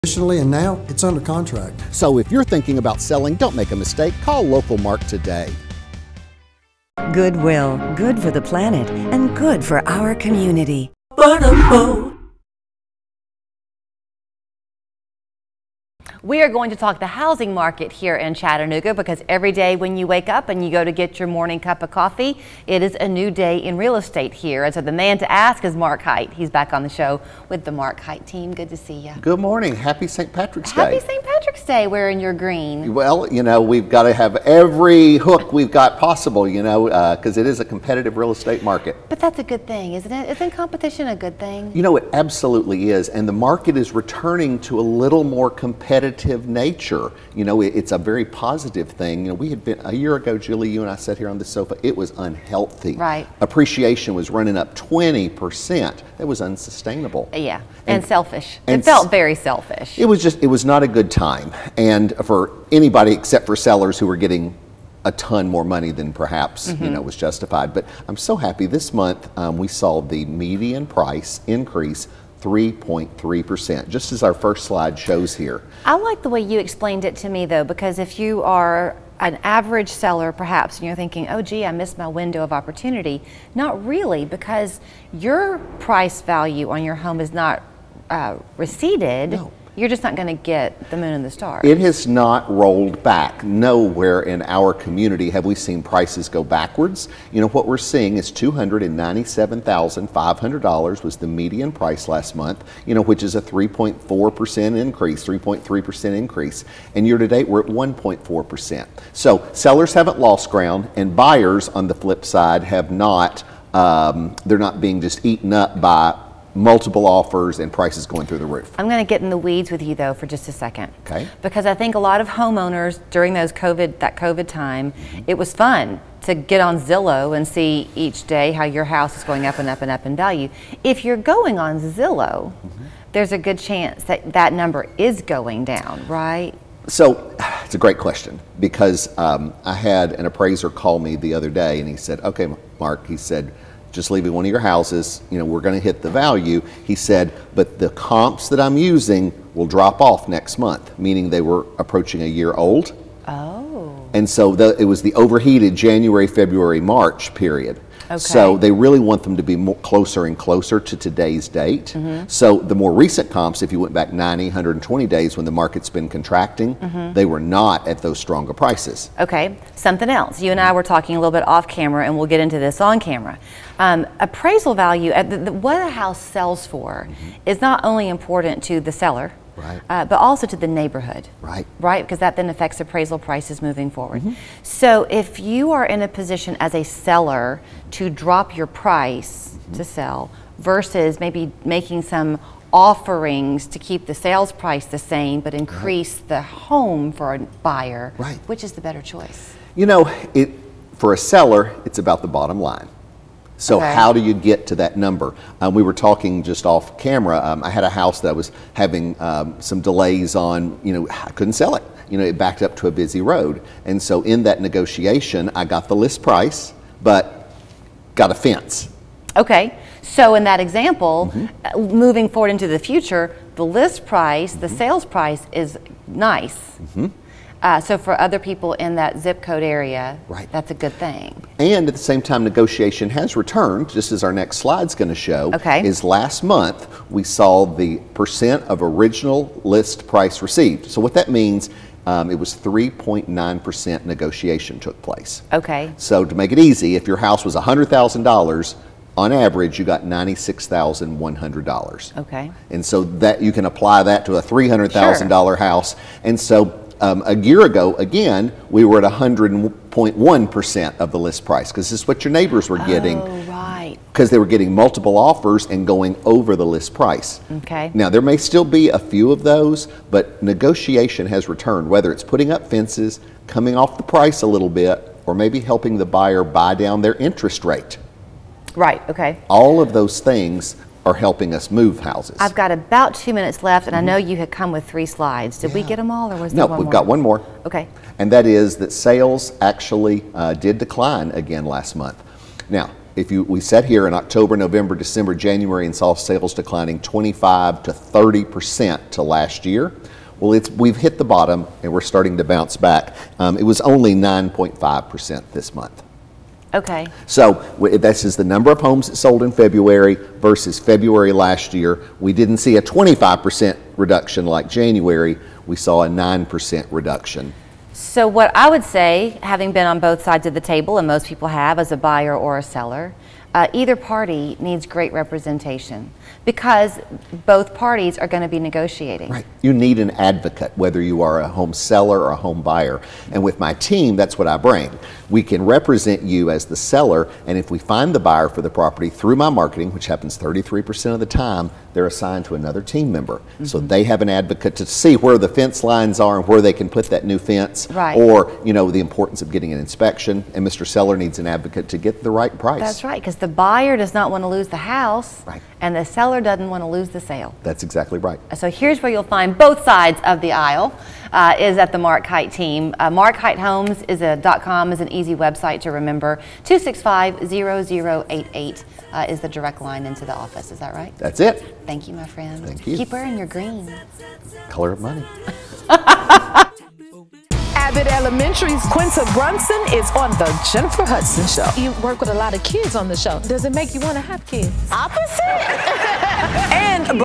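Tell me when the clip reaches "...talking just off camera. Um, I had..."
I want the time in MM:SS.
03:25.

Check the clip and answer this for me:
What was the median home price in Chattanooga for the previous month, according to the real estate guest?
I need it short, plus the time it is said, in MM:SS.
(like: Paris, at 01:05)
$297,500, at 01:38.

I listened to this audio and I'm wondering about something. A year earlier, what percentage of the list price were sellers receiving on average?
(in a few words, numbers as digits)
100.1%.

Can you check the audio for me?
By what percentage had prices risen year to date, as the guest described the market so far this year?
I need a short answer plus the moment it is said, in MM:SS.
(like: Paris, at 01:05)
1.4%, at 01:47.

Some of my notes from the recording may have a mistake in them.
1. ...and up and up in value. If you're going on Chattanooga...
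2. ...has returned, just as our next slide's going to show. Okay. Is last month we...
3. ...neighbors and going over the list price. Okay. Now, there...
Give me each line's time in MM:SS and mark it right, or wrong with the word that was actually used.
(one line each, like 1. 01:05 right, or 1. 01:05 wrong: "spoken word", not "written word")
1. 02:09 wrong: "Zillow", not "Chattanooga"
2. 03:53 right
3. 04:25 wrong: "offers", not "neighbors".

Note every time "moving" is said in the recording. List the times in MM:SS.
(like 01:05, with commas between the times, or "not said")
03:03, 03:41.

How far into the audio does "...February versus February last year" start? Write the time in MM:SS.
05:09.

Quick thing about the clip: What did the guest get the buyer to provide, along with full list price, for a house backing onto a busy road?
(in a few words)
a fence.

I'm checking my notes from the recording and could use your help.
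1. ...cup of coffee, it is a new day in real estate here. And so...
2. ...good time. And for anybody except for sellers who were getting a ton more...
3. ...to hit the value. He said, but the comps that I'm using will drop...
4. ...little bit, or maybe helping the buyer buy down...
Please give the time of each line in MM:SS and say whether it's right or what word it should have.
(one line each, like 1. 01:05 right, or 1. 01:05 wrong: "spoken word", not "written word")
1. 00:21 right
2. 01:00 right
3. 02:25 right
4. 04:34 right.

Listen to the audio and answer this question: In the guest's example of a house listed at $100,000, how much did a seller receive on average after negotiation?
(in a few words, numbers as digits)
$96,100.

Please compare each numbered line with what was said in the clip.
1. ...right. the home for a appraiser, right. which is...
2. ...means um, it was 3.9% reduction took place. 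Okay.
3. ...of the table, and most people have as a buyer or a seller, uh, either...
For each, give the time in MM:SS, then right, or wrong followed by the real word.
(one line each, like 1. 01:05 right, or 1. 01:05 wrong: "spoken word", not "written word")
1. 03:16 wrong: "buyer", not "appraiser"
2. 04:01 wrong: "negotiation", not "reduction"
3. 05:20 right.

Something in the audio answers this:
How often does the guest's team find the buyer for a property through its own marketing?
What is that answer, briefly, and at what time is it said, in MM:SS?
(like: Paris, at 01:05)
33% of the time, at 05:40.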